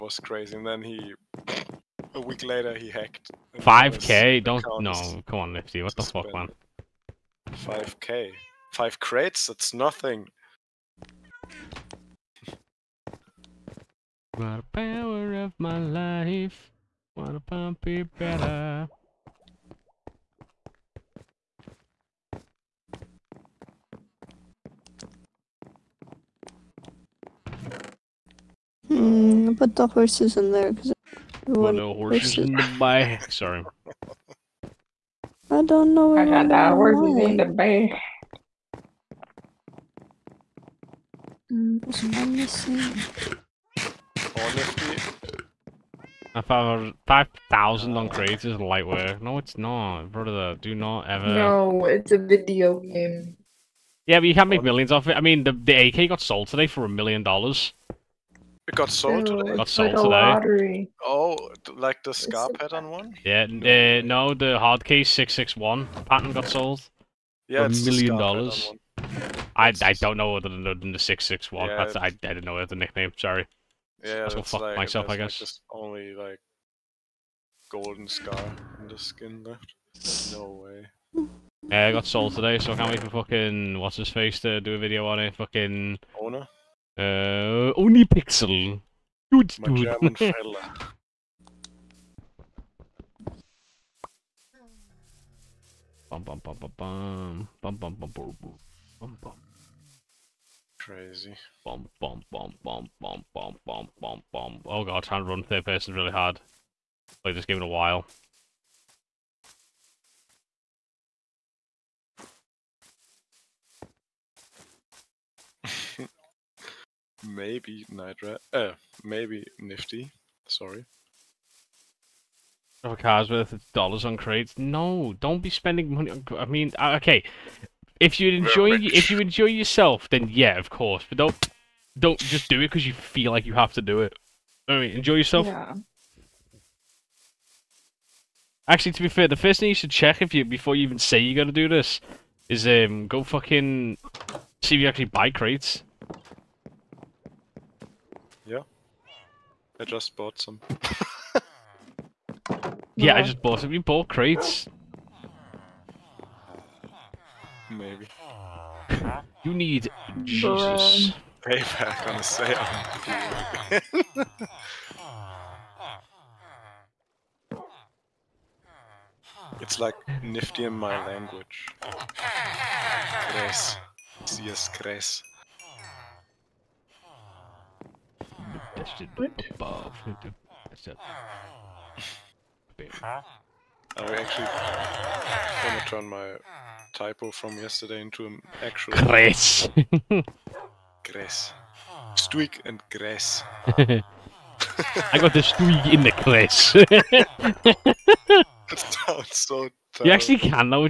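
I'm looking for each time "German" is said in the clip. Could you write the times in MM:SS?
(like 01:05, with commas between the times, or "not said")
01:29.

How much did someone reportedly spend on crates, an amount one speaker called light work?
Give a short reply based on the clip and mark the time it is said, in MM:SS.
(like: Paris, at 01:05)
5,000, at 00:47.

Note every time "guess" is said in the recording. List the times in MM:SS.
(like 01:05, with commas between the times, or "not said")
01:15.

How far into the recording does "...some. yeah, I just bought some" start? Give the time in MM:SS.
02:30.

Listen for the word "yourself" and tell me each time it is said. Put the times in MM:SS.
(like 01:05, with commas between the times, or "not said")
02:09, 02:15.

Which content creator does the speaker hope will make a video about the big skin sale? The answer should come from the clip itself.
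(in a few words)
ohnePixel.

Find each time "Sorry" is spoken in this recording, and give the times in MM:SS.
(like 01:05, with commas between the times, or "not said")
00:33, 01:13, 02:00.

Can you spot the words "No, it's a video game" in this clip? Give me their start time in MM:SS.
00:51.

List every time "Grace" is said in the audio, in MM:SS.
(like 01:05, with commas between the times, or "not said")
02:54.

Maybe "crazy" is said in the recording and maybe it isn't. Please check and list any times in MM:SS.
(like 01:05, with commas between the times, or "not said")
00:00, 01:40.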